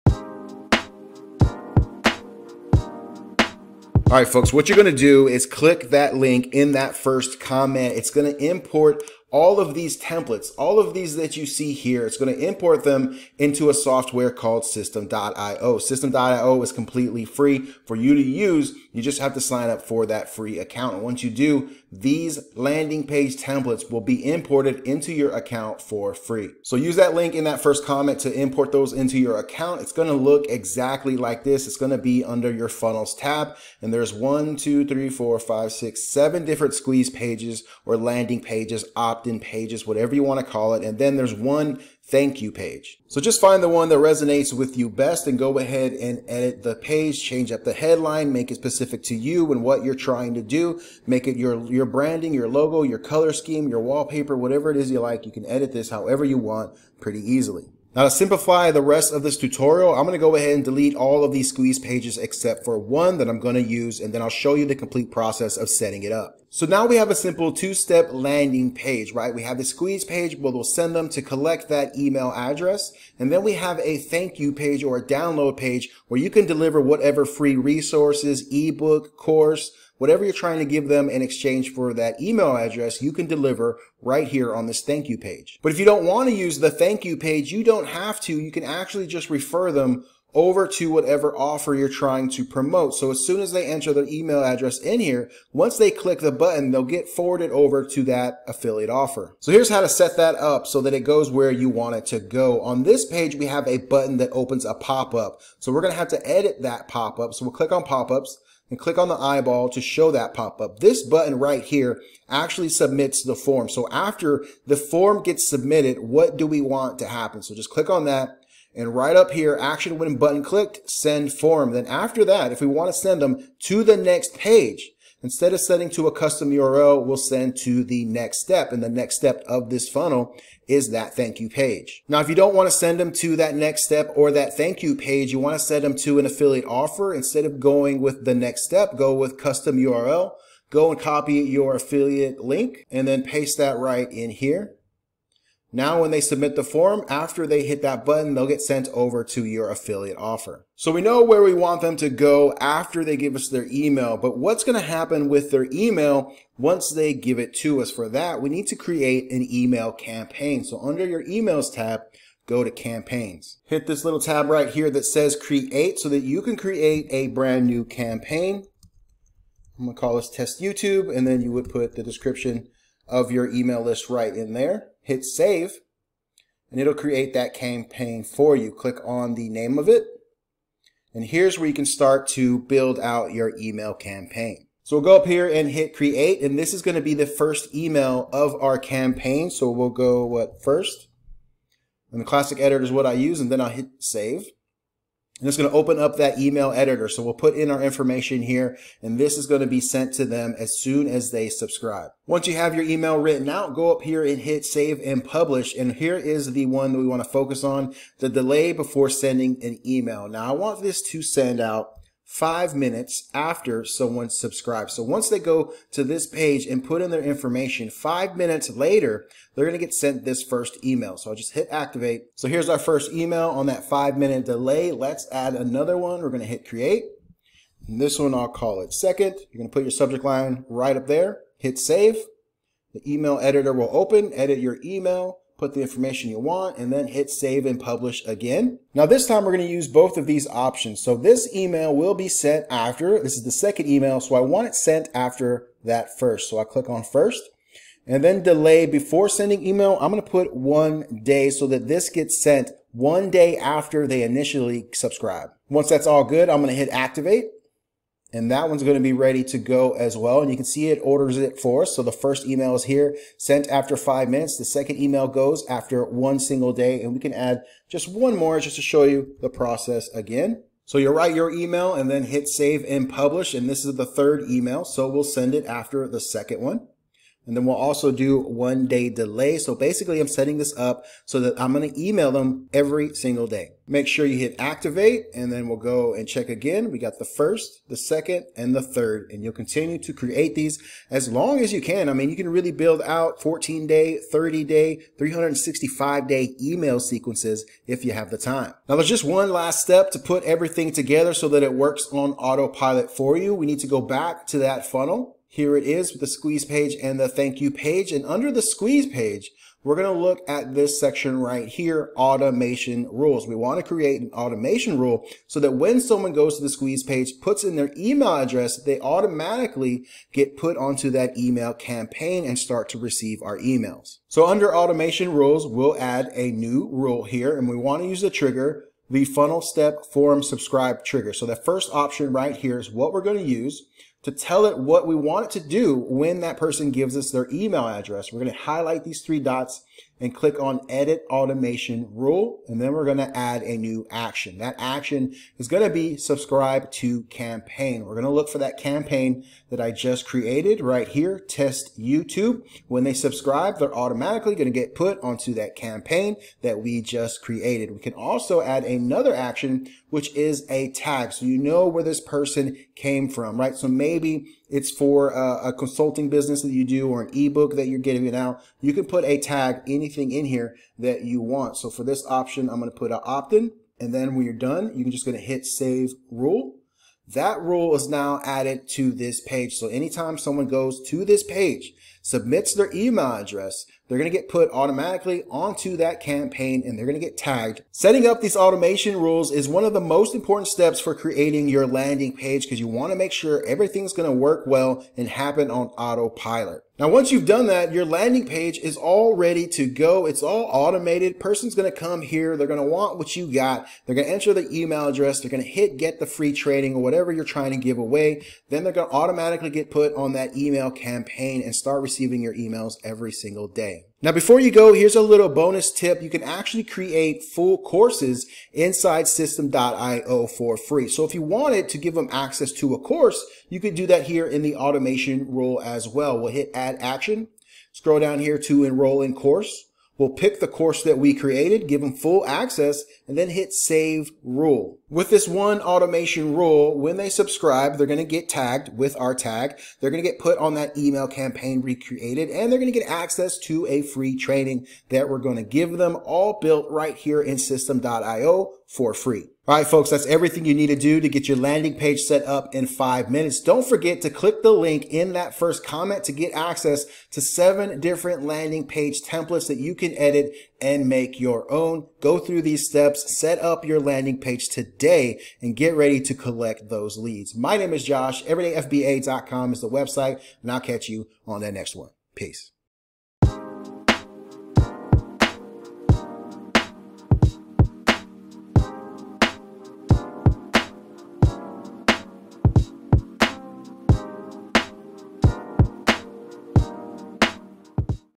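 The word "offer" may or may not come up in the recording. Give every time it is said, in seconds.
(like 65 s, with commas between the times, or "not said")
91 s, 98 s, 136 s, 150 s.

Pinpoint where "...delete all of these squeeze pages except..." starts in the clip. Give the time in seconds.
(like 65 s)
60 s.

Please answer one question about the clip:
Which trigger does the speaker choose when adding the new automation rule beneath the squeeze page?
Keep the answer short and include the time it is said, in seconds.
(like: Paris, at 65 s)
funnel step form subscribe, at 329 s.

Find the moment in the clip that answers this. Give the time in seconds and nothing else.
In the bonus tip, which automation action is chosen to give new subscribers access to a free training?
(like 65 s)
428 s.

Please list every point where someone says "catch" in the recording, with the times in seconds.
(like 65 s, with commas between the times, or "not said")
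470 s.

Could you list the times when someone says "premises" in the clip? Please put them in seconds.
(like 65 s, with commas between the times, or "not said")
not said.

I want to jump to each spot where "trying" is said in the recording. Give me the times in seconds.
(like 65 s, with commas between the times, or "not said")
49 s, 80 s, 91 s, 407 s.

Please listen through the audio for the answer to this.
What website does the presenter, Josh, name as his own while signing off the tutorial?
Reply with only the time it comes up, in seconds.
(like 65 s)
468 s.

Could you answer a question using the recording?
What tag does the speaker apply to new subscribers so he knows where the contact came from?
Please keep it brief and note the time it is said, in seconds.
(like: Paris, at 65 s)
opt-in, at 373 s.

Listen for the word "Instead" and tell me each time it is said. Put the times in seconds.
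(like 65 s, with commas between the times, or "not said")
125 s, 137 s.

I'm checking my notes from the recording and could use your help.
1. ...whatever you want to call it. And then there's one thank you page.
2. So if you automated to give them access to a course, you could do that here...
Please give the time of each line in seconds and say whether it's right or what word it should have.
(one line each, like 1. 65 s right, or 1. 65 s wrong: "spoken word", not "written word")
1. 39 s right
2. 421 s wrong: "wanted", not "automated".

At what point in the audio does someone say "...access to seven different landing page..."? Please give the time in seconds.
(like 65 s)
456 s.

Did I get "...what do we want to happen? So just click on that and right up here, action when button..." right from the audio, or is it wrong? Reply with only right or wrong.
right.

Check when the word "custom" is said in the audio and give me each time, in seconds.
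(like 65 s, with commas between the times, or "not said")
126 s, 139 s.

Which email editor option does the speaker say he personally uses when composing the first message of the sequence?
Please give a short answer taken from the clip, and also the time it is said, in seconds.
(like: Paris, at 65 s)
classic editor, at 192 s.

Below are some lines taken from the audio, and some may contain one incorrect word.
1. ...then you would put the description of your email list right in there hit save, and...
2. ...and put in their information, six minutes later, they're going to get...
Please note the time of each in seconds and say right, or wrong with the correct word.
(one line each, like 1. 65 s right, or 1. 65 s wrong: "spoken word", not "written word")
1. 171 s right
2. 216 s wrong: "five", not "six".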